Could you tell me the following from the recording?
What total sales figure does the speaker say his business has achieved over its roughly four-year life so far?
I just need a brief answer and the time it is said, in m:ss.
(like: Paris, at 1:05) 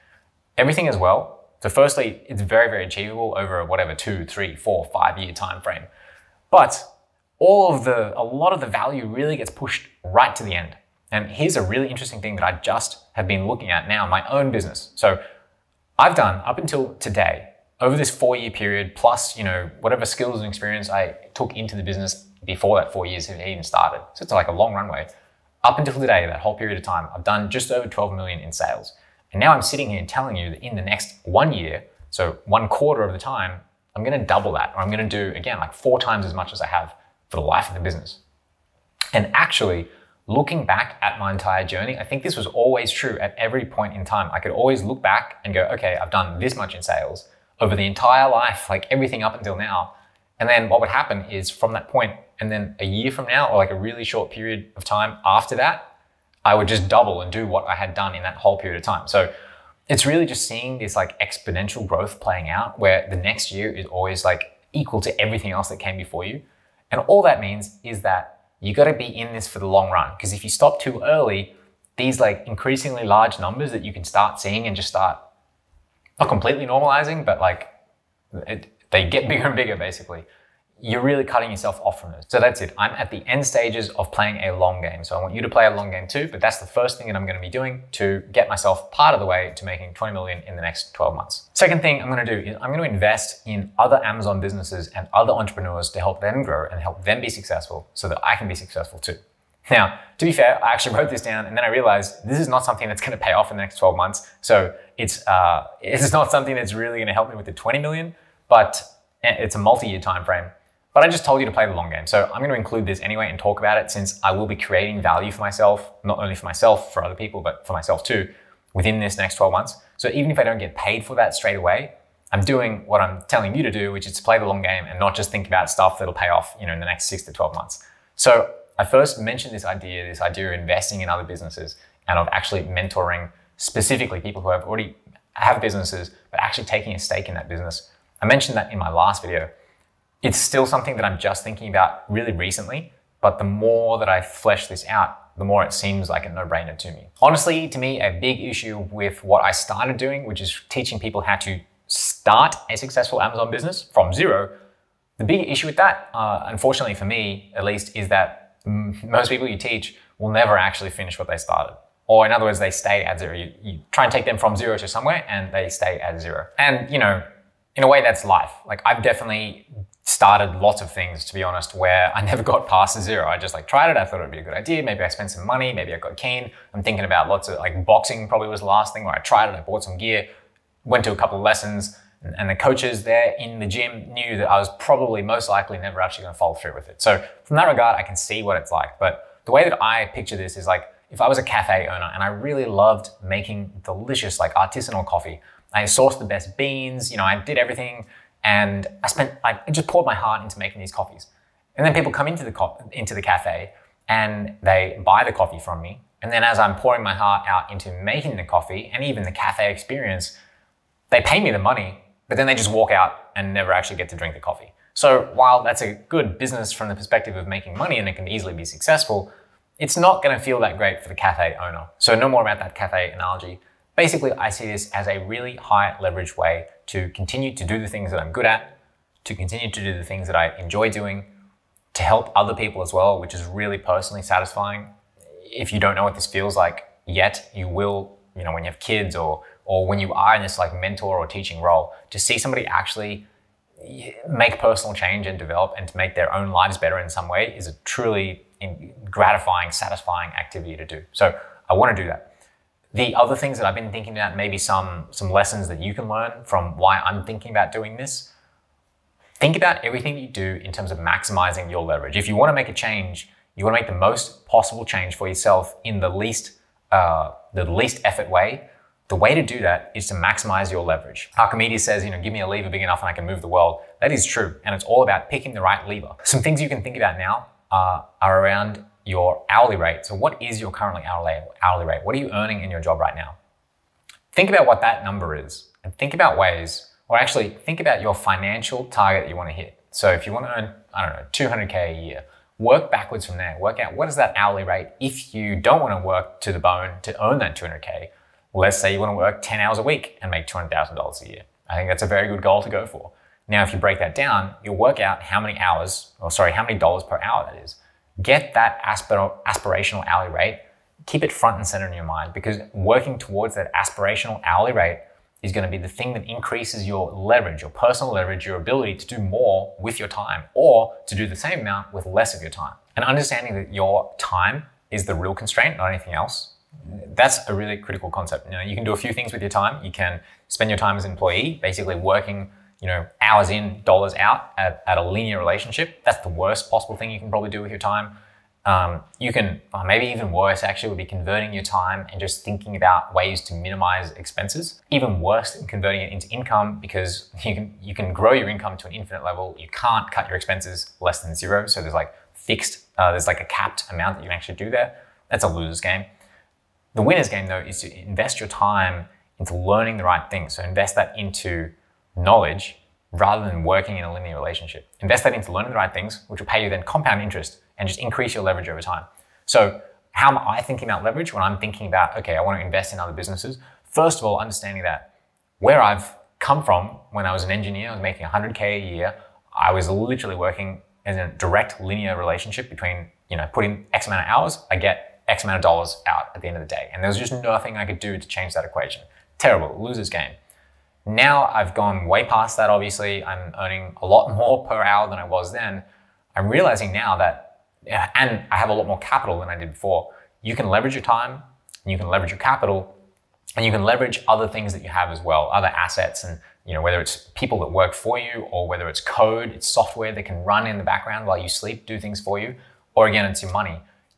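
12 million, at 0:27.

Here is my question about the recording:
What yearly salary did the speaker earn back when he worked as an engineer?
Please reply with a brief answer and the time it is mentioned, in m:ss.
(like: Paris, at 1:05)
100K, at 6:18.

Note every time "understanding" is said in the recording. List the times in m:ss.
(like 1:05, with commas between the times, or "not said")
5:23, 6:14.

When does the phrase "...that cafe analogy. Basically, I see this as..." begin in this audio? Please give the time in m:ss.
3:42.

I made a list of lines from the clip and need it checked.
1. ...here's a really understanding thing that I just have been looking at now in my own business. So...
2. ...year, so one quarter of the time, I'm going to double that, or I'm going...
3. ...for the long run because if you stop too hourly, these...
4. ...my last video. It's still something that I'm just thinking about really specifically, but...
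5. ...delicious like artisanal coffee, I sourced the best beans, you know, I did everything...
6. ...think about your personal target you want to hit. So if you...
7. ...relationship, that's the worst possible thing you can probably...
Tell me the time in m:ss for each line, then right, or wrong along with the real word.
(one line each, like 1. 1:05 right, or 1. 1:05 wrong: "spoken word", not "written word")
1. 0:11 wrong: "interesting", not "understanding"
2. 0:31 right
3. 1:09 wrong: "early", not "hourly"
4. 2:18 wrong: "recently", not "specifically"
5. 3:13 right
6. 4:47 wrong: "financial", not "personal"
7. 5:35 right.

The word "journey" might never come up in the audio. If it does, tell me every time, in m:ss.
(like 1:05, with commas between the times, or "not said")
0:41.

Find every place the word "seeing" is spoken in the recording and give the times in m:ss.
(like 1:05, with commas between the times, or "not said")
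1:00, 1:14.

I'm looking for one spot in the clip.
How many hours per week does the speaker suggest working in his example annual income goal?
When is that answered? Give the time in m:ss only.
4:59.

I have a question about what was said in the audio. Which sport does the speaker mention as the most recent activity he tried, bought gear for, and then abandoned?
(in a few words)
Boxing.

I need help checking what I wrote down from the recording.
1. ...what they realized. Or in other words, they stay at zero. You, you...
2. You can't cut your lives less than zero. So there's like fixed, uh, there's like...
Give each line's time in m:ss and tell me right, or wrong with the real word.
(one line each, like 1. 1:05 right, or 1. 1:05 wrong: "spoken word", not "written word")
1. 2:41 wrong: "started", not "realized"
2. 5:49 wrong: "expenses", not "lives".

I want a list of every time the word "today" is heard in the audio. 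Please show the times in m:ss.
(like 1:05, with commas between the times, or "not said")
0:16, 0:25.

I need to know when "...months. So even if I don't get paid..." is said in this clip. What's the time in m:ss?
1:59.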